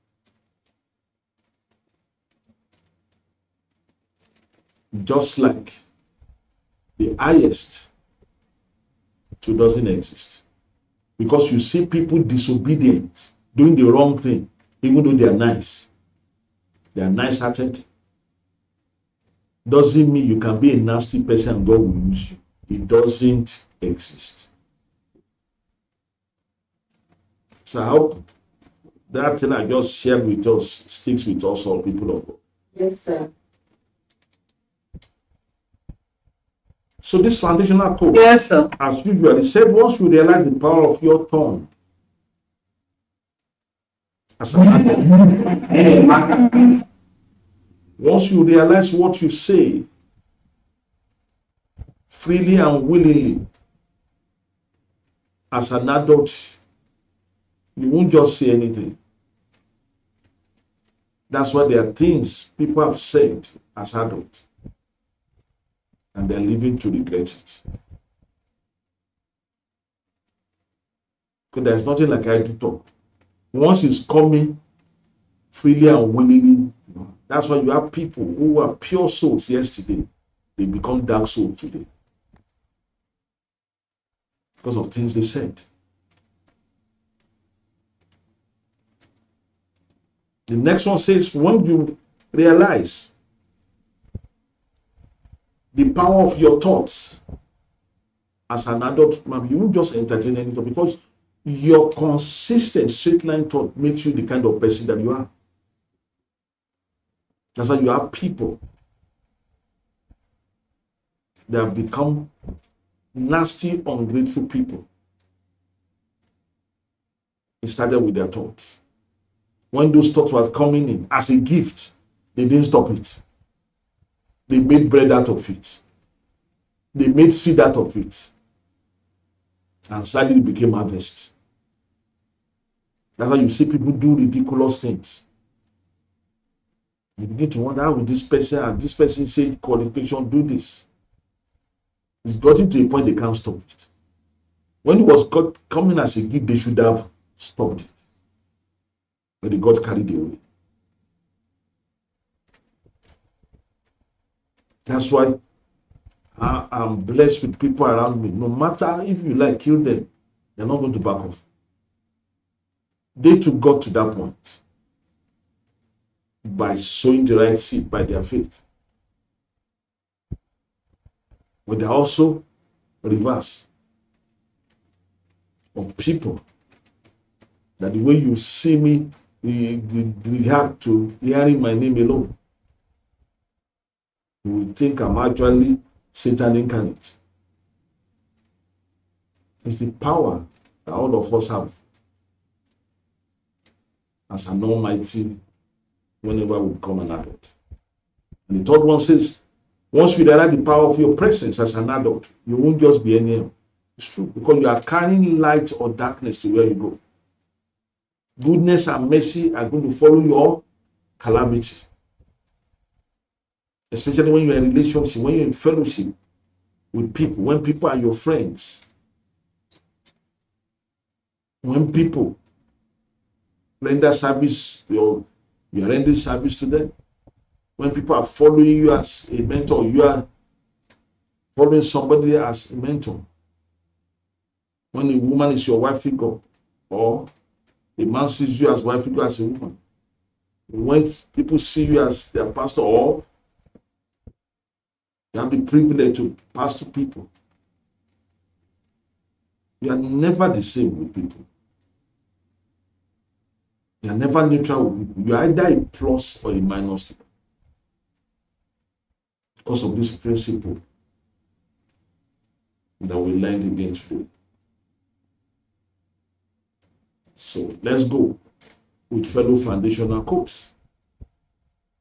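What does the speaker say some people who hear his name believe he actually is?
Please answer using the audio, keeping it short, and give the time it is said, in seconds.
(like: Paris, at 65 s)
Satan incarnate, at 186 s.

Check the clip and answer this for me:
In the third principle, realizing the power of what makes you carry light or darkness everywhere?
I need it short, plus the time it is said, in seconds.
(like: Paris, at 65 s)
Presence, at 201 s.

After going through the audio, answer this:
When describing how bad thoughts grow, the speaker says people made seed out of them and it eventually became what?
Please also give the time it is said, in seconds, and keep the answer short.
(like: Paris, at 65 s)
Harvest, at 130 s.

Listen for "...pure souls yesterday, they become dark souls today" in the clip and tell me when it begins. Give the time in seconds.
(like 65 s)
78 s.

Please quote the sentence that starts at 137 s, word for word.
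You begin to wonder how will this person and this person say qualification do this.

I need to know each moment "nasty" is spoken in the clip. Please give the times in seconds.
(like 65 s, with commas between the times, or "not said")
20 s, 113 s.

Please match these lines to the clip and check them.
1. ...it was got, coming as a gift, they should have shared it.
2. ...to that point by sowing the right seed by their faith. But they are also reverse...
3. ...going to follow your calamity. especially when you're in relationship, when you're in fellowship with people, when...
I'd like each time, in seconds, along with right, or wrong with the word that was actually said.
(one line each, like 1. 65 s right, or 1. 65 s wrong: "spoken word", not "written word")
1. 144 s wrong: "stopped", not "shared"
2. 163 s right
3. 209 s right.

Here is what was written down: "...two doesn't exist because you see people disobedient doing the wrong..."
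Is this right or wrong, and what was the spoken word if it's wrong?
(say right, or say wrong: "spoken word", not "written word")
right.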